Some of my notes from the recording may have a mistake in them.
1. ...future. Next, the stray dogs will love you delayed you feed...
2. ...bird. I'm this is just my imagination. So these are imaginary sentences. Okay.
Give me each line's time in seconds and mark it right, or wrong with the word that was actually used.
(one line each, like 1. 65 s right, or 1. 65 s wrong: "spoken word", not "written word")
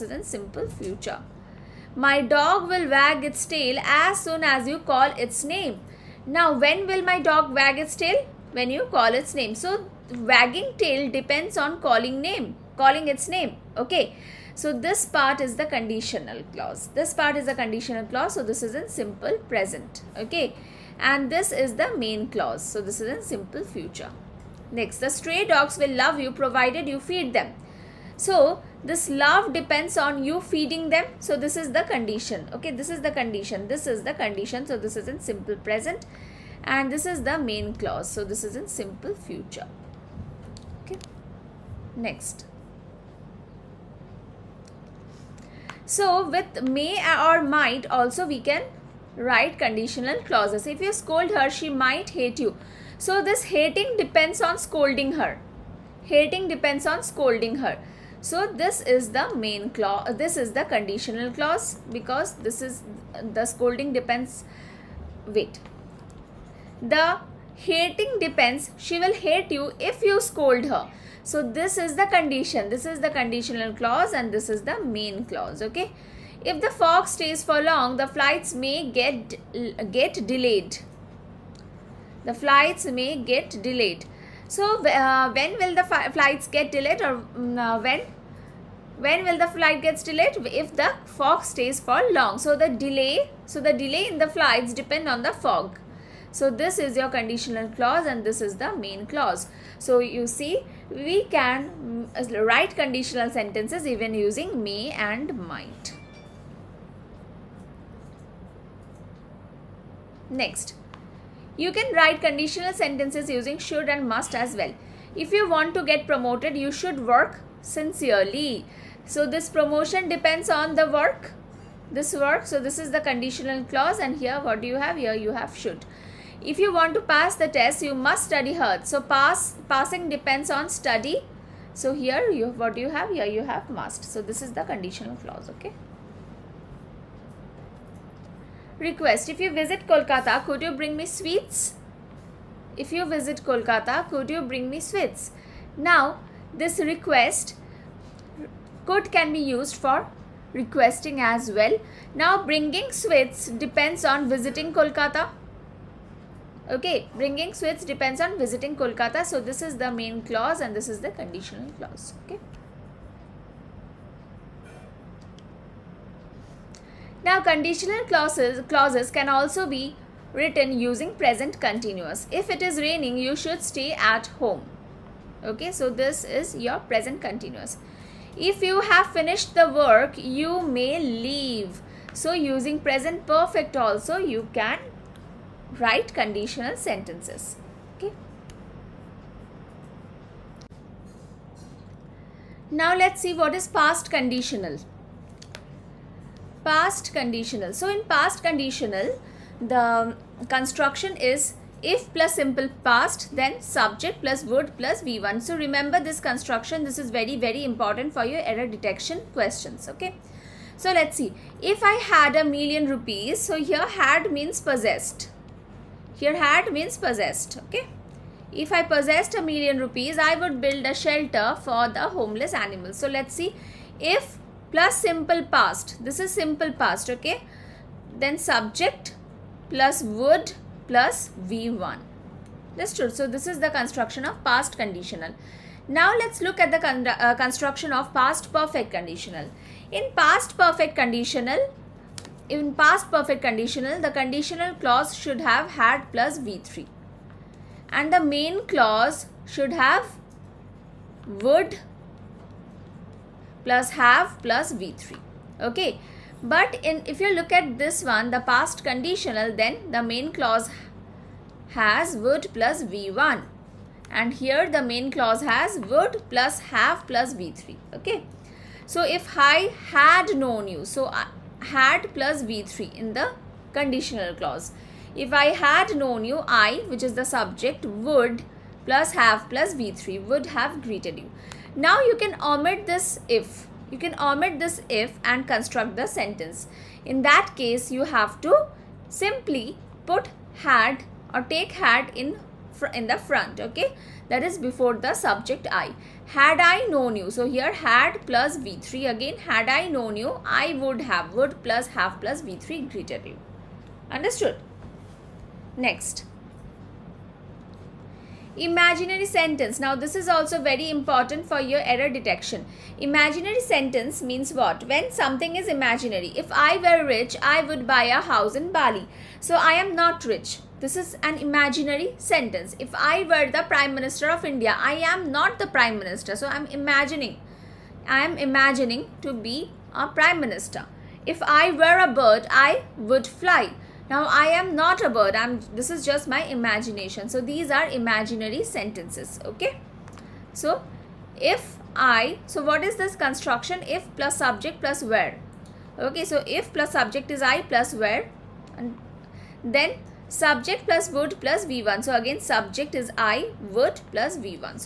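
1. 23 s wrong: "provided", not "delayed"
2. 335 s right.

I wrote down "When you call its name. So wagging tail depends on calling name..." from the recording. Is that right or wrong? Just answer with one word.
right.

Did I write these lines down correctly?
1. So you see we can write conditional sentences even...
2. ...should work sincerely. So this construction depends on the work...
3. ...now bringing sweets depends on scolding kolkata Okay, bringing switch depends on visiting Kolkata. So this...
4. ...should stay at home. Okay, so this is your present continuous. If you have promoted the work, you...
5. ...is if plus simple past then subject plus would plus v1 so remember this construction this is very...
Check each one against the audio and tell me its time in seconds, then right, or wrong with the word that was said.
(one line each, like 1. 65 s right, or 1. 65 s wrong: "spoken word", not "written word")
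1. 99 s right
2. 116 s wrong: "promotion", not "construction"
3. 152 s wrong: "visiting", not "scolding"
4. 173 s wrong: "finished", not "promoted"
5. 201 s right.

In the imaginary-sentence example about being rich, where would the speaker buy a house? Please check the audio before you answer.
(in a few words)
Bali.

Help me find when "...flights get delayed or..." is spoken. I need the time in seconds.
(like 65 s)
86 s.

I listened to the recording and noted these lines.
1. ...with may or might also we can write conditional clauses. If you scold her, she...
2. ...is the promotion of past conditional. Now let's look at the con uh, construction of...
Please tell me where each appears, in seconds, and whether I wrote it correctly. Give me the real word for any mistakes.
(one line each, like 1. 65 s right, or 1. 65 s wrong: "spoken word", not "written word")
1. 46 s right
2. 233 s wrong: "construction", not "promotion".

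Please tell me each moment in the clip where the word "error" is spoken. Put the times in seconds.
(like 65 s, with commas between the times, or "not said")
208 s, 311 s.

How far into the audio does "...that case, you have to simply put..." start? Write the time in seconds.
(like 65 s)
287 s.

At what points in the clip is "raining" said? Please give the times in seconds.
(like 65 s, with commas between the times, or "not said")
172 s.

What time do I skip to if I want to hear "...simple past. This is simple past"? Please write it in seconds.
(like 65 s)
224 s.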